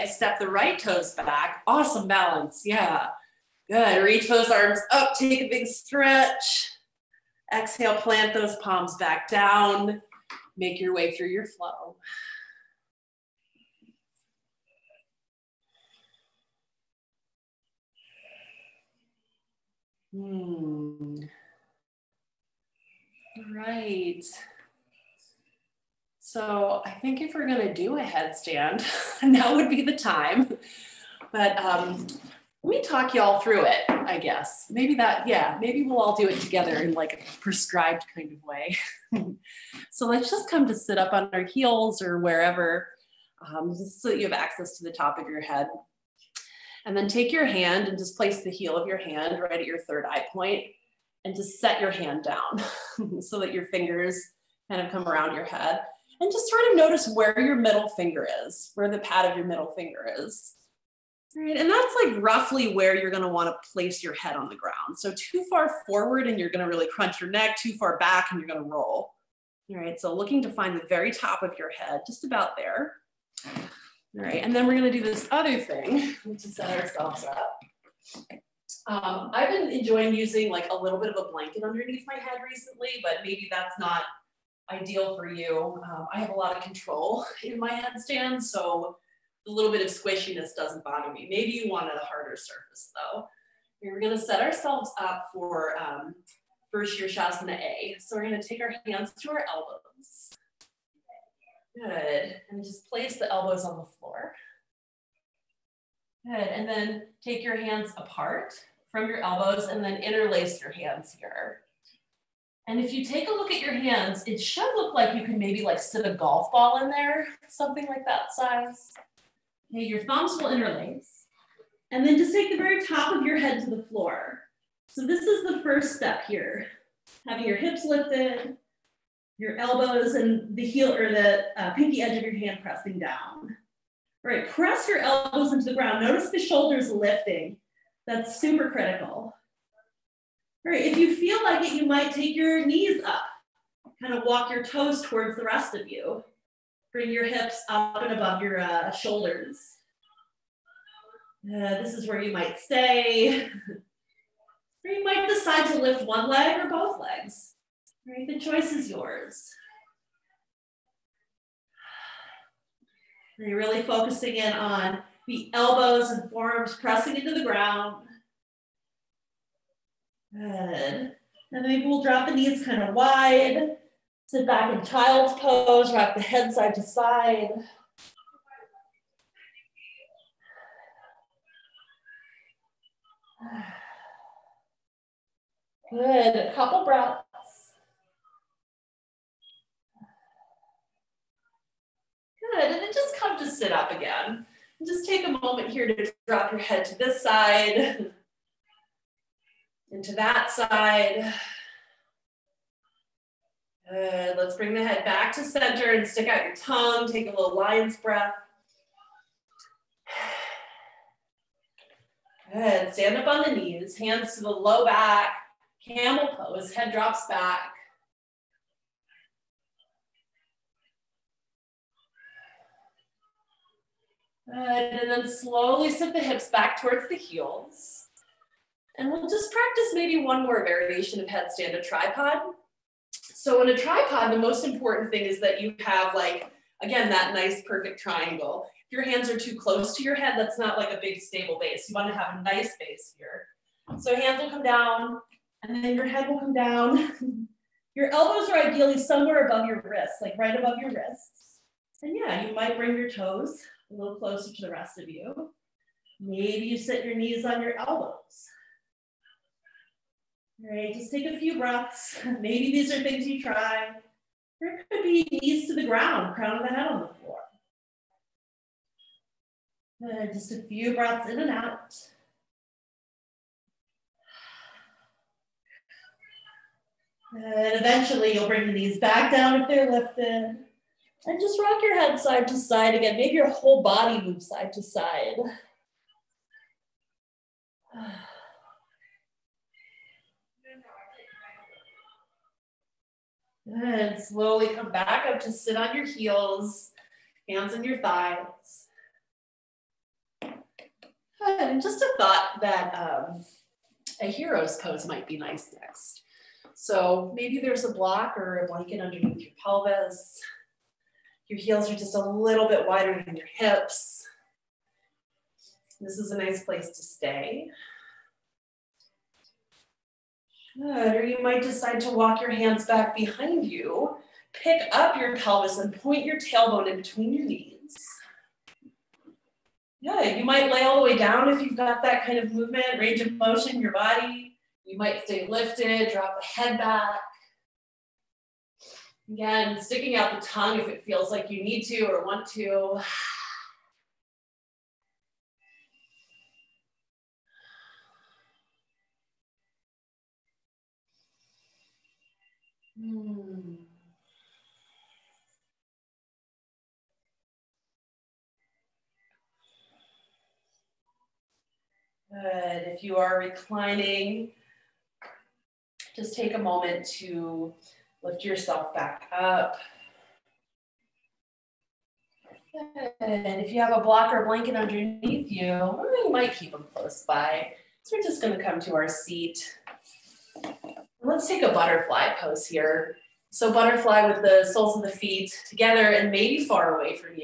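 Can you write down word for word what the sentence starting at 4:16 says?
Maybe you sit your knees on your elbows.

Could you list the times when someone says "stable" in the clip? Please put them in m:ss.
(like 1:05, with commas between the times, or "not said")
4:01.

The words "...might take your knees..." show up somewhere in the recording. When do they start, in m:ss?
2:21.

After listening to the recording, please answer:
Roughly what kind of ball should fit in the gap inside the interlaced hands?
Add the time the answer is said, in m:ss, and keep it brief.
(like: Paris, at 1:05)
A golf ball, at 1:56.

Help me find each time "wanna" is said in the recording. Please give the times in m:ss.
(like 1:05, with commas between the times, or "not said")
1:03, 4:01.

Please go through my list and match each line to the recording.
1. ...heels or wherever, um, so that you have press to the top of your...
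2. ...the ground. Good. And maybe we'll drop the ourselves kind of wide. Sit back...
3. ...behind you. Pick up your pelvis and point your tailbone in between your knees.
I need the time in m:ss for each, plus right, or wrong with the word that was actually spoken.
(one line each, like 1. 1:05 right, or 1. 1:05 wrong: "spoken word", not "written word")
1. 0:41 wrong: "access", not "press"
2. 2:47 wrong: "knees", not "ourselves"
3. 5:23 right.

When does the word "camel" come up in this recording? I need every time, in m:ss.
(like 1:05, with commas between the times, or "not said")
3:35.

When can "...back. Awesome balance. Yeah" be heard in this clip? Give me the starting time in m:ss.
0:01.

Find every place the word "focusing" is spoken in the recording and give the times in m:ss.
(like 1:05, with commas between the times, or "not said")
2:43.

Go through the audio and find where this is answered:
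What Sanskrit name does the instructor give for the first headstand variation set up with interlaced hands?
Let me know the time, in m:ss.
1:36.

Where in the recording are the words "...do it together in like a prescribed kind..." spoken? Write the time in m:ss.
0:36.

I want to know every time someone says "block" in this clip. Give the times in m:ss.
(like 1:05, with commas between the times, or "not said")
5:07, 6:14.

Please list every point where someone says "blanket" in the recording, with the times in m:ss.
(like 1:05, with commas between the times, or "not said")
1:21, 5:08, 6:14.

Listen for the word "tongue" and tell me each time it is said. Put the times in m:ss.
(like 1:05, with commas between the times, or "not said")
3:26, 5:40.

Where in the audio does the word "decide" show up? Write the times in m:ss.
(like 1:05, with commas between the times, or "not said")
2:35, 5:21.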